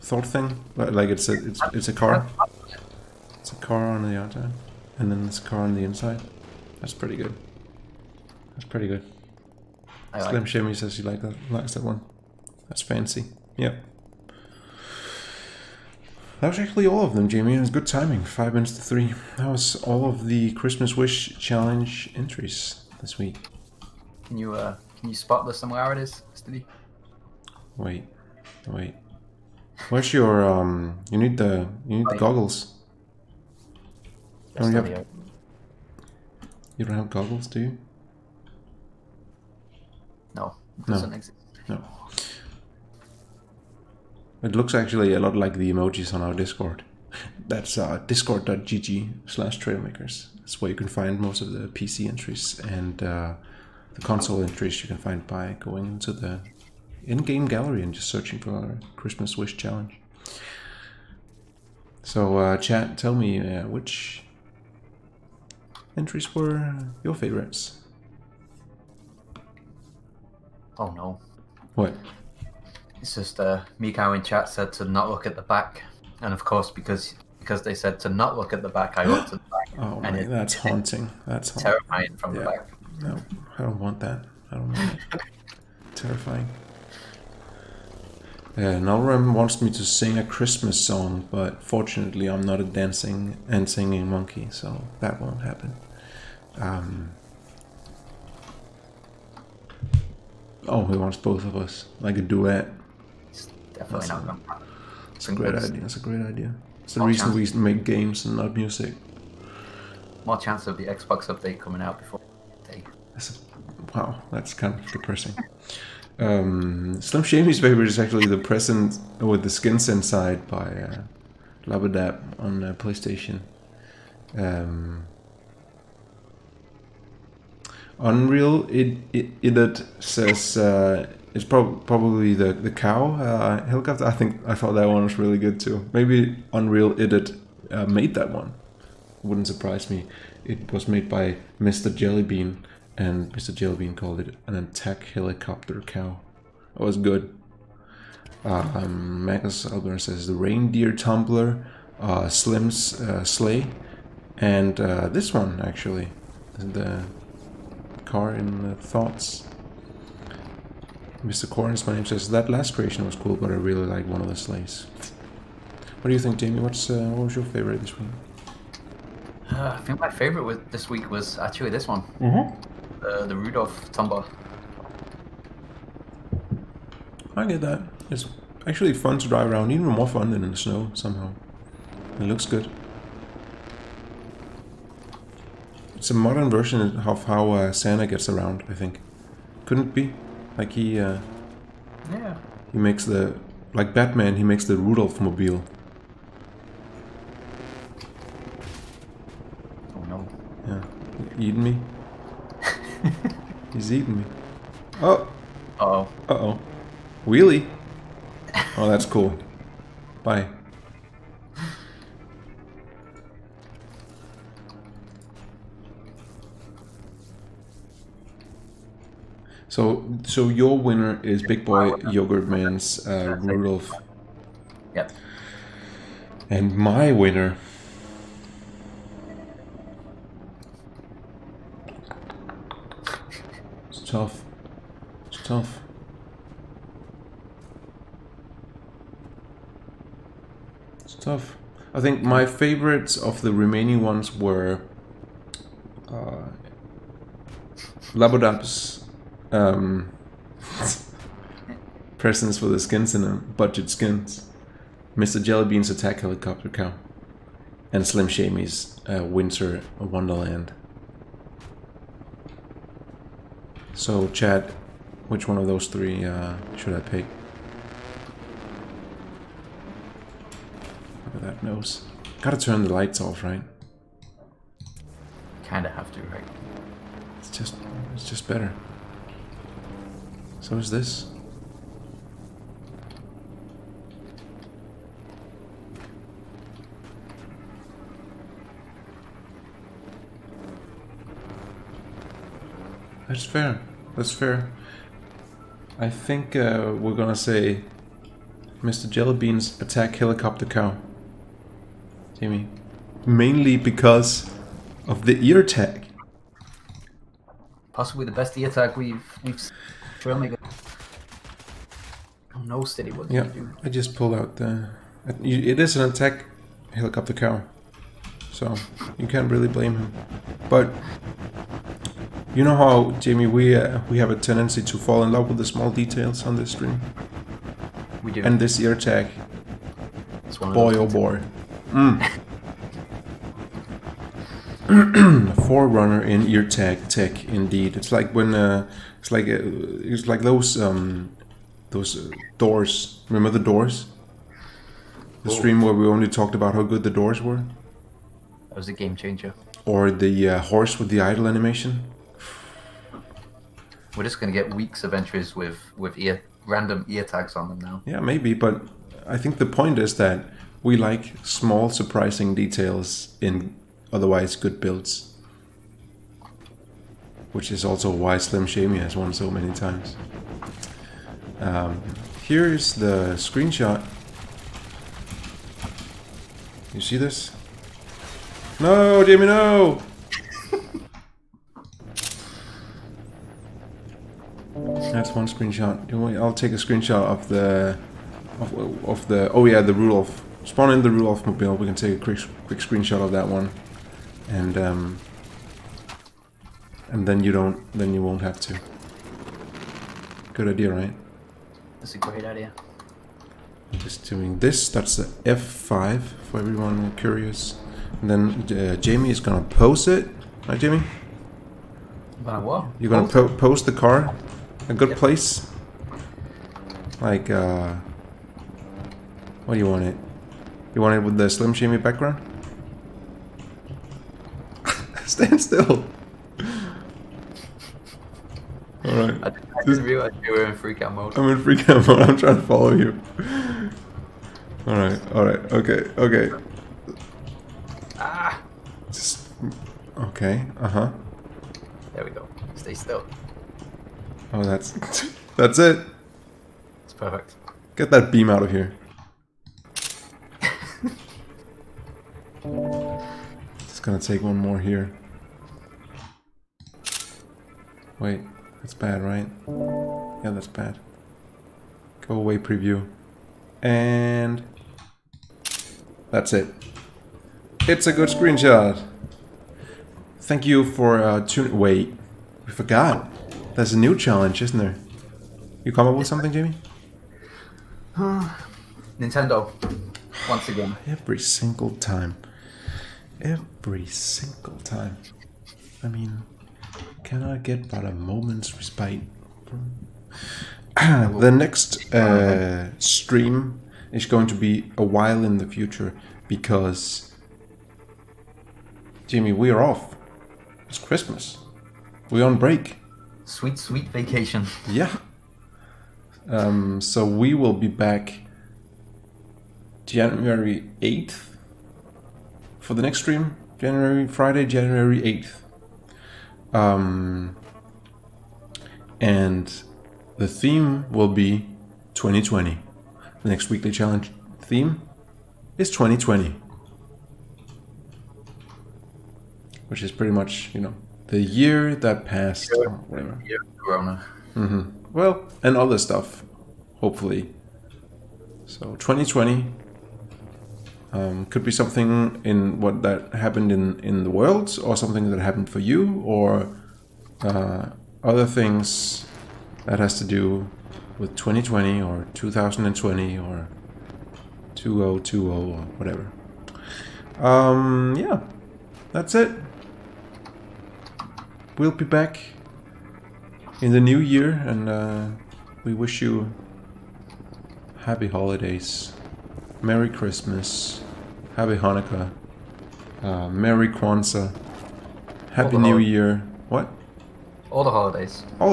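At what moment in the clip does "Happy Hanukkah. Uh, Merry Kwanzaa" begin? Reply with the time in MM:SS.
09:31.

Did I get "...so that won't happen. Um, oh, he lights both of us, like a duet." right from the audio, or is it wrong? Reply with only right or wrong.
wrong.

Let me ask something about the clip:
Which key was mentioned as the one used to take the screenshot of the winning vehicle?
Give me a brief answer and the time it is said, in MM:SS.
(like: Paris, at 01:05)
F5, at 06:44.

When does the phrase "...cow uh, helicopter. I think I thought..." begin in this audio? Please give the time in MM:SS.
02:12.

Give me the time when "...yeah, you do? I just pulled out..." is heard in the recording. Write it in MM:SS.
05:13.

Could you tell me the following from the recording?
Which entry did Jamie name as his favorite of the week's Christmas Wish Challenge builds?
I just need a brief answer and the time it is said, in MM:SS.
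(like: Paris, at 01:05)
the Rudolph Tumbler, at 02:53.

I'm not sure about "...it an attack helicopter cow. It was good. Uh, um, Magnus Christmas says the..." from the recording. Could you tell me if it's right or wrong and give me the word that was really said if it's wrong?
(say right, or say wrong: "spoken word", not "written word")
wrong: "Albert", not "Christmas".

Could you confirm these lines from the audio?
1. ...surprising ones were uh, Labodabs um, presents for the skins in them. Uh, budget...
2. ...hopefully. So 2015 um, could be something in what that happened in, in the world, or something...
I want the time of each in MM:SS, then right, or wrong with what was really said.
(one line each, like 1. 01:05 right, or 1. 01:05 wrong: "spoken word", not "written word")
1. 04:03 wrong: "remaining", not "surprising"
2. 08:56 wrong: "2020", not "2015".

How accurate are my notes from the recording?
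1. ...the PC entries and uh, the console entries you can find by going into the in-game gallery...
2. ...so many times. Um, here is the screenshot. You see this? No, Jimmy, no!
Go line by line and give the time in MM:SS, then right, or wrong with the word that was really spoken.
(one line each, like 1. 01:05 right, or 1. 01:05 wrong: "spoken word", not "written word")
1. 00:51 right
2. 06:09 right.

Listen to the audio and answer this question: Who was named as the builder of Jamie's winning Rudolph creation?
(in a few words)
Big Boy Yogurt Man.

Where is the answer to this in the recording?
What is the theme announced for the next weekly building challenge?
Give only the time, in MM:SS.
08:40.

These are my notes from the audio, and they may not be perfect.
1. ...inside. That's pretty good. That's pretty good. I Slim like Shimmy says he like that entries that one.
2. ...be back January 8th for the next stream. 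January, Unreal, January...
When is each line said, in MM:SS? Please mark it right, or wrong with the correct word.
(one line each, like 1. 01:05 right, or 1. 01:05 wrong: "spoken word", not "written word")
1. 00:05 wrong: "likes", not "entries"
2. 08:27 wrong: "Friday", not "Unreal".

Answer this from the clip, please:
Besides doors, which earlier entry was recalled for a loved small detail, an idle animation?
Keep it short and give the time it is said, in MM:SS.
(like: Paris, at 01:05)
horse, at 05:50.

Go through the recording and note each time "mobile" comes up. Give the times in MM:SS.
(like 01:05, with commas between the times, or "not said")
03:15, 06:31.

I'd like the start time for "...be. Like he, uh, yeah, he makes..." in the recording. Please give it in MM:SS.
03:09.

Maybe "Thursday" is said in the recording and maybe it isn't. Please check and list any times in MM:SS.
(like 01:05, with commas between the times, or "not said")
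not said.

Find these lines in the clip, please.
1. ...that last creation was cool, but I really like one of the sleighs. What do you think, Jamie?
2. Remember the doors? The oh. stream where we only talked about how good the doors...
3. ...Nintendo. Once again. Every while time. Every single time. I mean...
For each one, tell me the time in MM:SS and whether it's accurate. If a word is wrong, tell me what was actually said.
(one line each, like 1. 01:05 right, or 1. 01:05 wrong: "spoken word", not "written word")
1. 02:42 right
2. 05:43 right
3. 07:59 wrong: "single", not "while".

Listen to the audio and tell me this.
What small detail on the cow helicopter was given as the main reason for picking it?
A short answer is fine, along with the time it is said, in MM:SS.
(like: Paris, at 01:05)
the ear tag, at 05:03.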